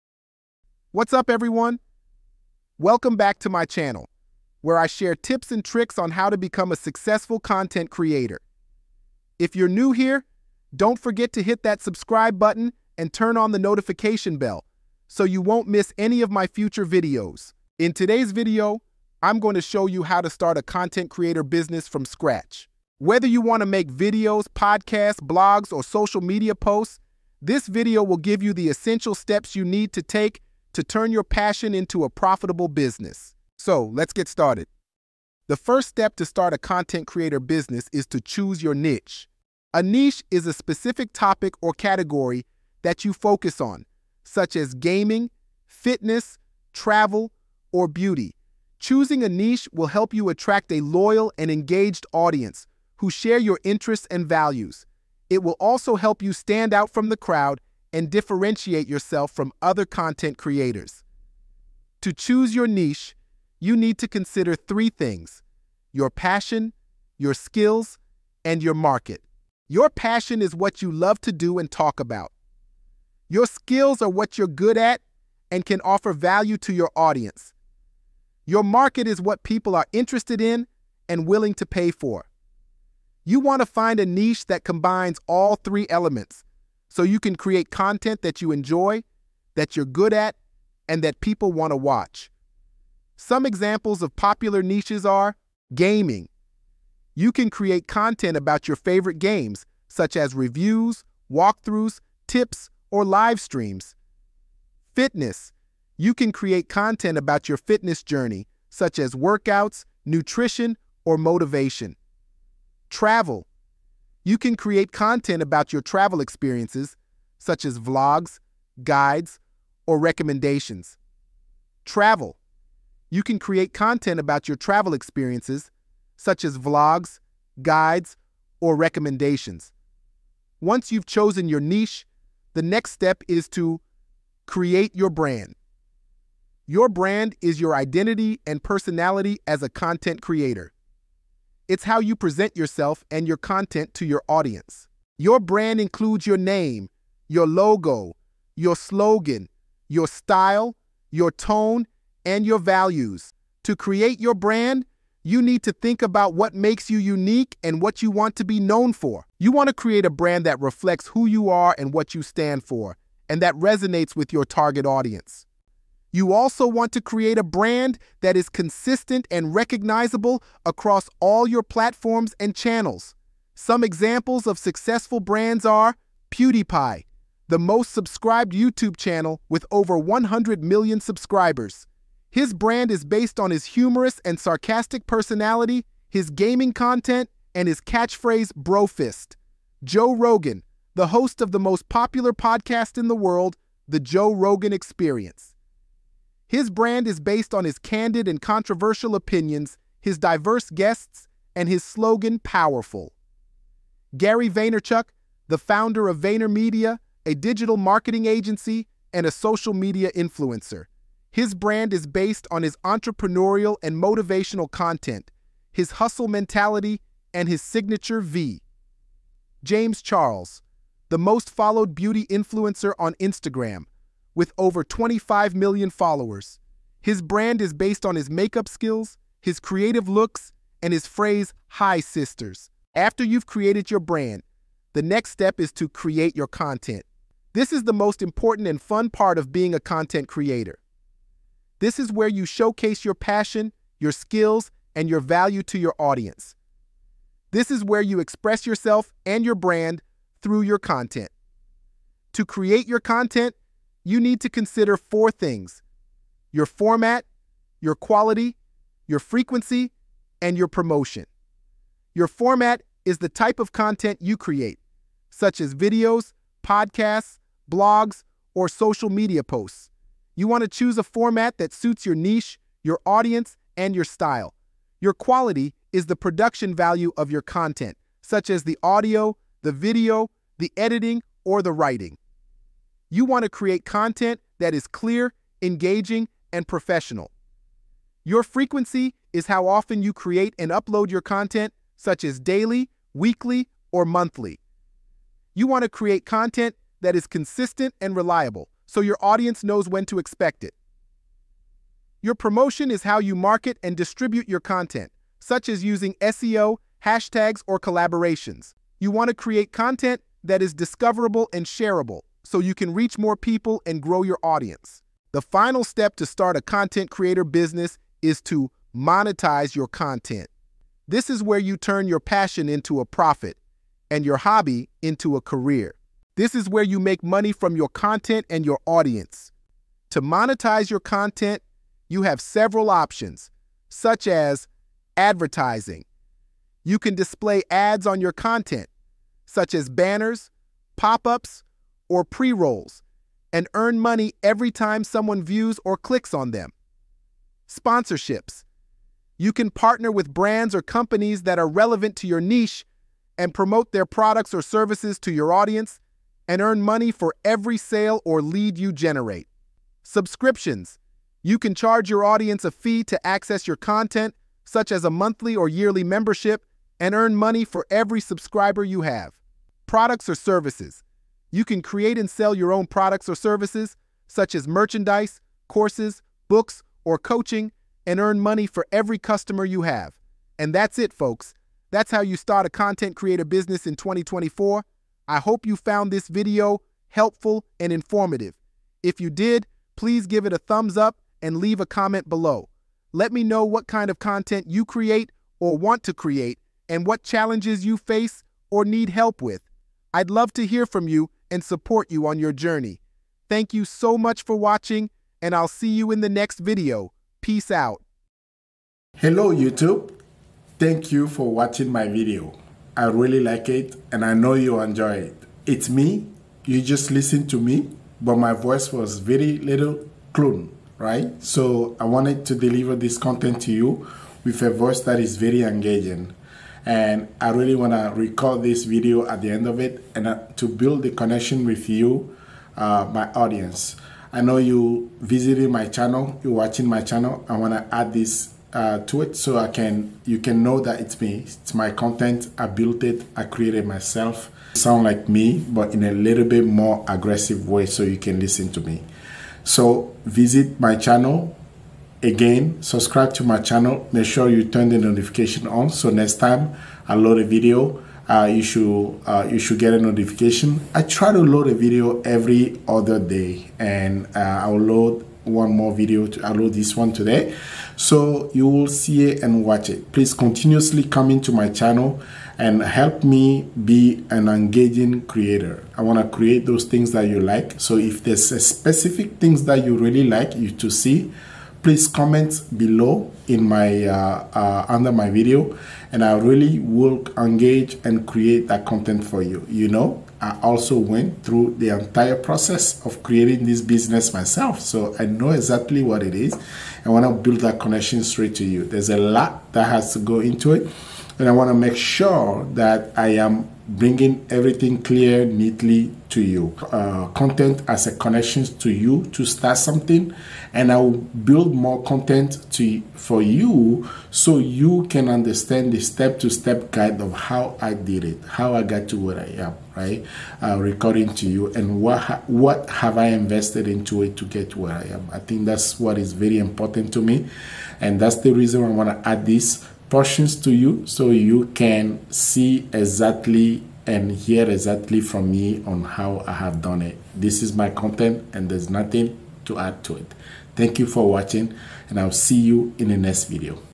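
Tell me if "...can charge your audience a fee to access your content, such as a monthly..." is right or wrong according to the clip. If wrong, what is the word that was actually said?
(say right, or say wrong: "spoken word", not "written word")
right.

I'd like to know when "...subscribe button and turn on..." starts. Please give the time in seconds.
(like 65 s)
11 s.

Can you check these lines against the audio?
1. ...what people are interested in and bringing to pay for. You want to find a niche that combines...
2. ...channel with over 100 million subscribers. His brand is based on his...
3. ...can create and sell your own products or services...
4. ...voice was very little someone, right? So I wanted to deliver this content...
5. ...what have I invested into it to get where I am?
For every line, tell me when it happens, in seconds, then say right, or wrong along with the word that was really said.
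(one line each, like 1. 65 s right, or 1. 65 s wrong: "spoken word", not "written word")
1. 79 s wrong: "willing", not "bringing"
2. 178 s right
3. 371 s right
4. 418 s wrong: "clone", not "someone"
5. 522 s right.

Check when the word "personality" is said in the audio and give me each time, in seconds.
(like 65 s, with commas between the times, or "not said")
138 s, 185 s.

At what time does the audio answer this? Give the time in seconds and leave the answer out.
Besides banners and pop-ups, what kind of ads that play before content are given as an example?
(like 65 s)
342 s.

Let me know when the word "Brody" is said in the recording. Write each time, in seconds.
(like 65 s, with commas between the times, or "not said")
not said.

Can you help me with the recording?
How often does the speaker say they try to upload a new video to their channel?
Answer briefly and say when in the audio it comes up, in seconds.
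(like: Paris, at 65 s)
every other day, at 462 s.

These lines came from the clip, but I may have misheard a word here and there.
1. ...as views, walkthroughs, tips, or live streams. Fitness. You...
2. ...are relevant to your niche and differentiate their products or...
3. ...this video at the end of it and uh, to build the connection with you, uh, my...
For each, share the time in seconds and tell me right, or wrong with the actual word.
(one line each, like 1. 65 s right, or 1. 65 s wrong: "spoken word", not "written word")
1. 100 s wrong: "reviews", not "views"
2. 351 s wrong: "promote", not "differentiate"
3. 428 s right.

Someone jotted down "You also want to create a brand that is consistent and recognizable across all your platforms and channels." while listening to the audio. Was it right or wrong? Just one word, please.
right.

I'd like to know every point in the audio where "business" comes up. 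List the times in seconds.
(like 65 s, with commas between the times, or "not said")
21 s, 32 s, 37 s, 317 s, 383 s, 493 s.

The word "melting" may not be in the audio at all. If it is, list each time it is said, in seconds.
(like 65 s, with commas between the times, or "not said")
not said.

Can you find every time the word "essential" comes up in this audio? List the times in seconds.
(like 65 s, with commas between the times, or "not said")
28 s.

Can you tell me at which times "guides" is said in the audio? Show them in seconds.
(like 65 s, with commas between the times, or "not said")
118 s, 127 s, 516 s.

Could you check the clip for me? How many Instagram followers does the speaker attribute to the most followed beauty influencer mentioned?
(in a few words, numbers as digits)
over 25 million.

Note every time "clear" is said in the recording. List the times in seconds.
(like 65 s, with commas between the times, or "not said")
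284 s, 505 s.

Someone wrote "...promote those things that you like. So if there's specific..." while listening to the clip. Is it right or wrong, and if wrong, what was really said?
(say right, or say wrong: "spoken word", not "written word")
wrong: "create", not "promote".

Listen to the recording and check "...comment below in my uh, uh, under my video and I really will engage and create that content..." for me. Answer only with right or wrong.
right.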